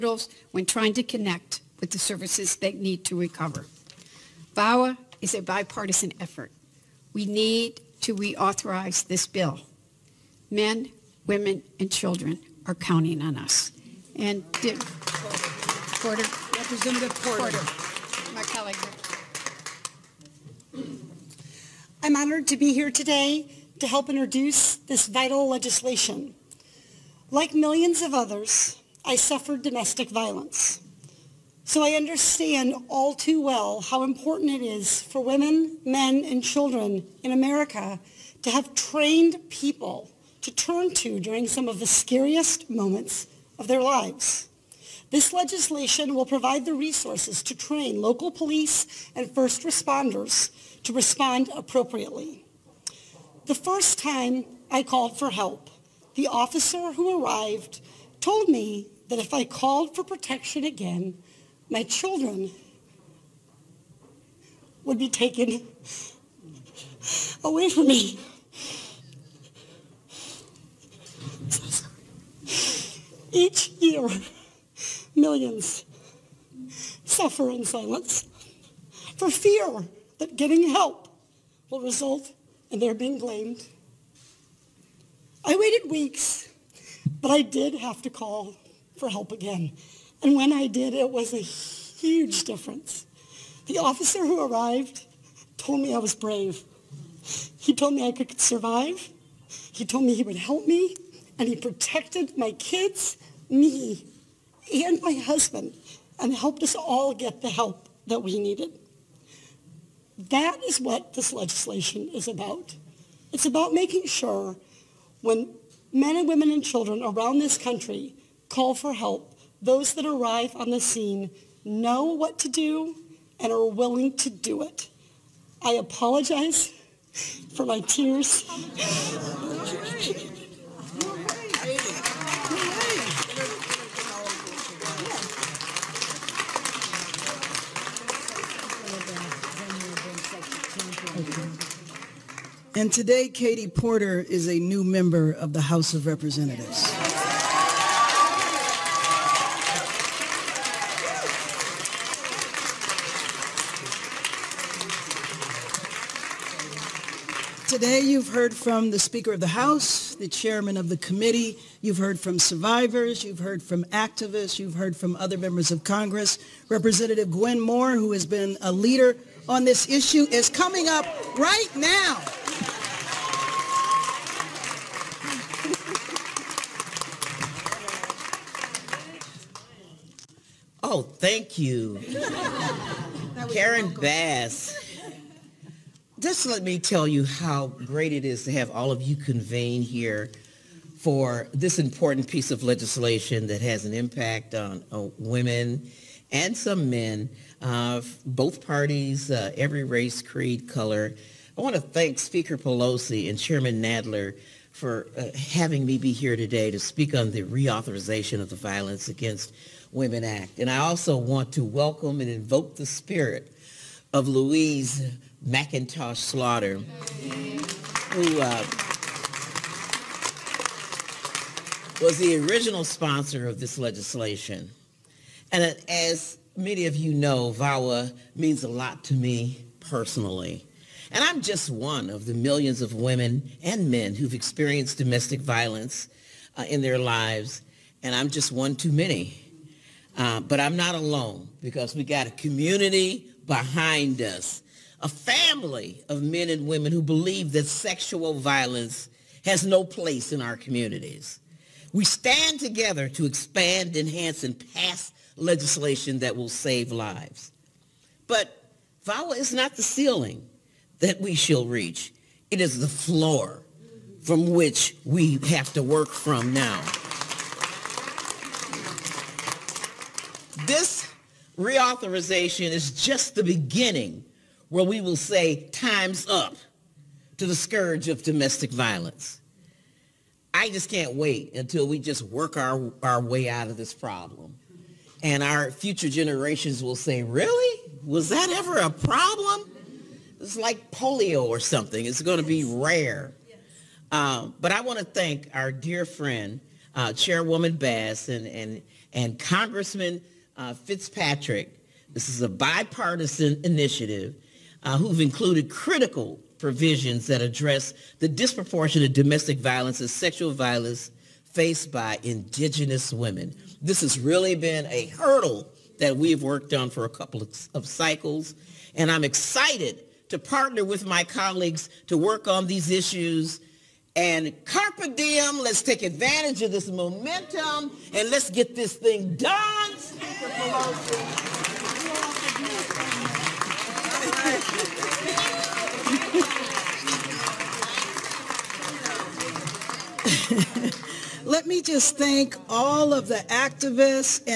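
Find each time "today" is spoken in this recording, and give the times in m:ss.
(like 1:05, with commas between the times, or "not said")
0:22, 2:22, 2:37, 3:26.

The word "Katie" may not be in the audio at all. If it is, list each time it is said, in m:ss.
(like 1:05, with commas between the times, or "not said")
2:23.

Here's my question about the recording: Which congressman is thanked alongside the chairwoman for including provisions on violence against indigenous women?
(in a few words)
Fitzpatrick.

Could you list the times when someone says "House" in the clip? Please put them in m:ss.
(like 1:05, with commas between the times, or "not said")
2:25, 2:39.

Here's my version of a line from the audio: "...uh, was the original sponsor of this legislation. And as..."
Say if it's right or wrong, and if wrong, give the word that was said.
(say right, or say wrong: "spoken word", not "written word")
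right.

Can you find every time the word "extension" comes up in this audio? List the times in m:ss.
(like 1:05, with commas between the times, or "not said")
not said.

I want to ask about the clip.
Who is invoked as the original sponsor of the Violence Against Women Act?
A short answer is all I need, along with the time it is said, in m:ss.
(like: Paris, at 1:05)
Louise McIntosh Slaughter, at 3:34.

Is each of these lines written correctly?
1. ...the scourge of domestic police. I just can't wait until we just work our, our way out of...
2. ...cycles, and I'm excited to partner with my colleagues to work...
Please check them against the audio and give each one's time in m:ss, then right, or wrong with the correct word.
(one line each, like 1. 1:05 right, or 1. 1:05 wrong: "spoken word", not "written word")
1. 4:37 wrong: "violence", not "police"
2. 5:17 right.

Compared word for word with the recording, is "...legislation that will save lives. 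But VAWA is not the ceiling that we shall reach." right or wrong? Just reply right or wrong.
right.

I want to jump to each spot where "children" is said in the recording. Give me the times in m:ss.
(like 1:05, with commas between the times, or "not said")
0:11, 0:36, 1:01, 1:56.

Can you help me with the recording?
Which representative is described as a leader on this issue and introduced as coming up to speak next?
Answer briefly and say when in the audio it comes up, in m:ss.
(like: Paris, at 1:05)
Gwen Moore, at 2:47.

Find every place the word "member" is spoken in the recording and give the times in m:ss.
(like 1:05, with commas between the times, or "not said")
2:24, 2:45.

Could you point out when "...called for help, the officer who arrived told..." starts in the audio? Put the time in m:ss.
0:54.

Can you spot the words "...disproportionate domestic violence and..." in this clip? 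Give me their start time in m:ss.
5:08.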